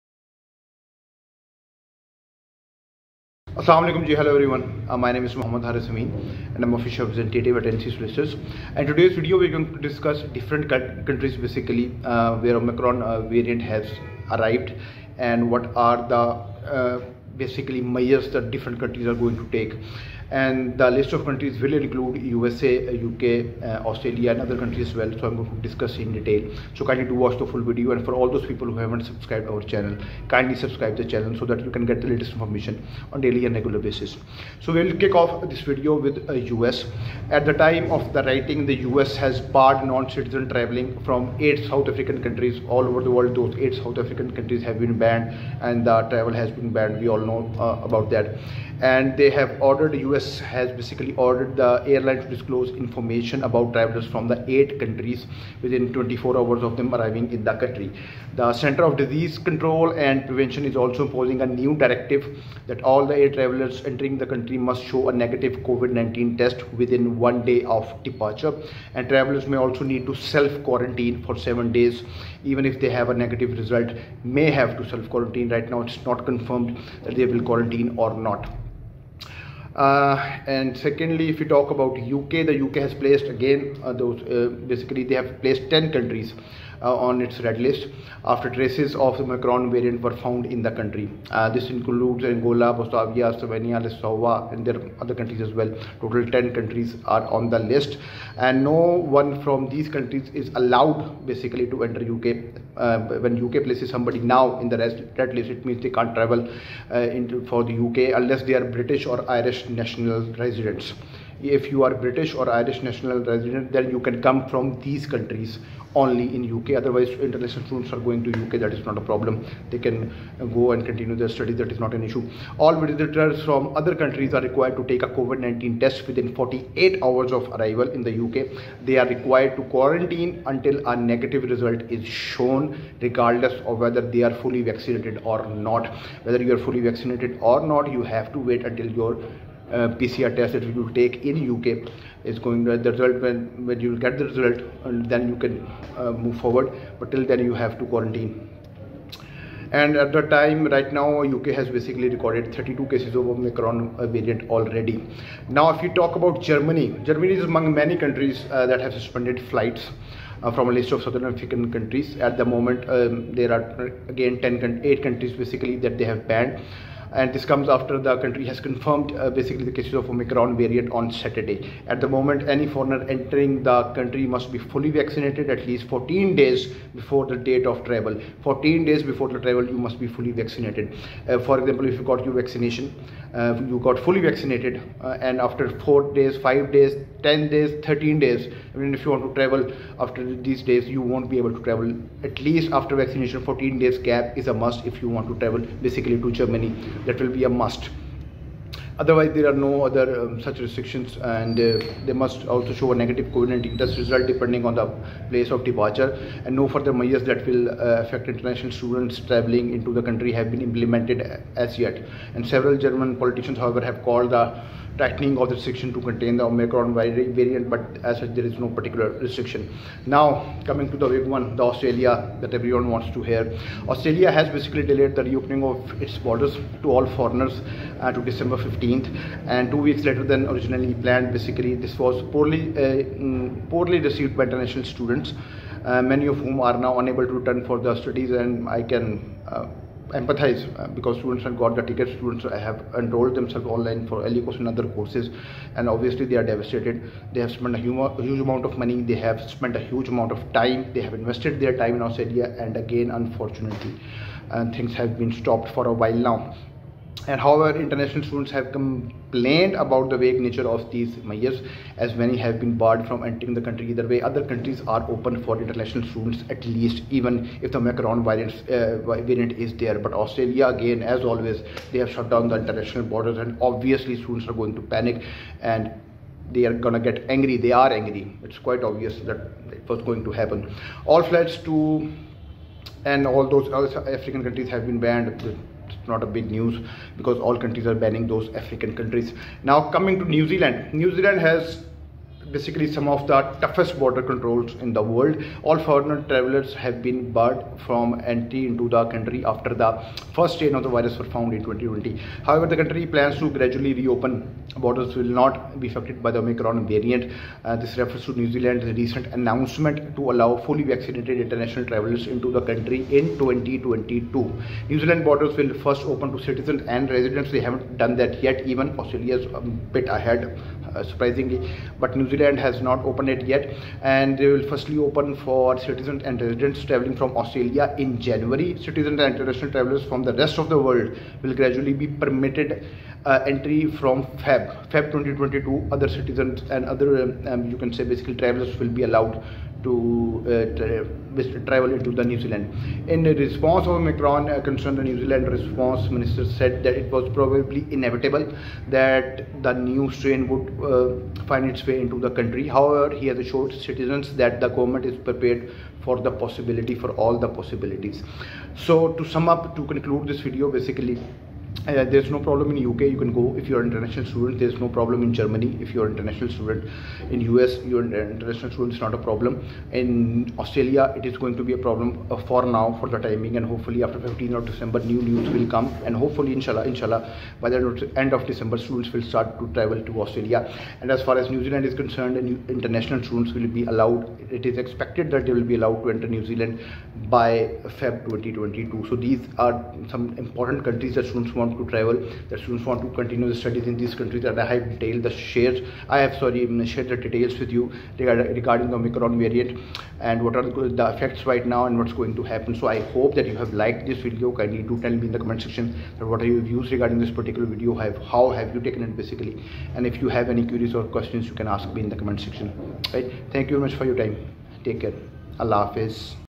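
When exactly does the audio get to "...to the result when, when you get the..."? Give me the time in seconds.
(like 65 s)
142 s.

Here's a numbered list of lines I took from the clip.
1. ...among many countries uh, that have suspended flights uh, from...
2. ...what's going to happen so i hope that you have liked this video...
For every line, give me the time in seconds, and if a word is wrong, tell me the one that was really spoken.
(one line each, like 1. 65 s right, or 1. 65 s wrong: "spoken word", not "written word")
1. 157 s right
2. 402 s right.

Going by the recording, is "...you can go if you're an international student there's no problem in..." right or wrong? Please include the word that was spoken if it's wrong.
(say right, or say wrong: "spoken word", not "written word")
right.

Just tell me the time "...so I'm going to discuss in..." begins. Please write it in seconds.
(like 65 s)
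25 s.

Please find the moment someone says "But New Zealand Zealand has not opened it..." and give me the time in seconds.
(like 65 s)
321 s.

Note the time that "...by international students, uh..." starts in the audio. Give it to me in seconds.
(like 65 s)
234 s.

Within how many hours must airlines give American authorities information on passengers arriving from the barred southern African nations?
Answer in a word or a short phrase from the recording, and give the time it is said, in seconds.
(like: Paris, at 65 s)
24, at 55 s.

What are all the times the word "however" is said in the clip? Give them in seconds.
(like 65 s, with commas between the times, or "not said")
213 s, 257 s, 302 s, 352 s.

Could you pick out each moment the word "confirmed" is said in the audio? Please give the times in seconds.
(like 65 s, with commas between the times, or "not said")
76 s, 168 s.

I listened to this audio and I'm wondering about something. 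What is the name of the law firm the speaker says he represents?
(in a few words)
NC Solicitors.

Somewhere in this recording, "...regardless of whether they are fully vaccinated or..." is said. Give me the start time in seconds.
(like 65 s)
133 s.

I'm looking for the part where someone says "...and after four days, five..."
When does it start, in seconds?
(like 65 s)
185 s.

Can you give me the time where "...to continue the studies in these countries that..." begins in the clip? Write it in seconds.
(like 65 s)
393 s.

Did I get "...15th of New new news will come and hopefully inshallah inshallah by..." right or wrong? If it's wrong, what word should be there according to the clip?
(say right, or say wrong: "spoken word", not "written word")
wrong: "December", not "New".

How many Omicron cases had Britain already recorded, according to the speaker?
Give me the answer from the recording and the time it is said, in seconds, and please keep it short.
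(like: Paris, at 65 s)
32, at 152 s.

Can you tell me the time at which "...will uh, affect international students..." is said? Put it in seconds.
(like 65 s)
207 s.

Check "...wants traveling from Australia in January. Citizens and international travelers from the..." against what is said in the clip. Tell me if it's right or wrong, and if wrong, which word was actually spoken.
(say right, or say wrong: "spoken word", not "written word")
wrong: "residents", not "wants".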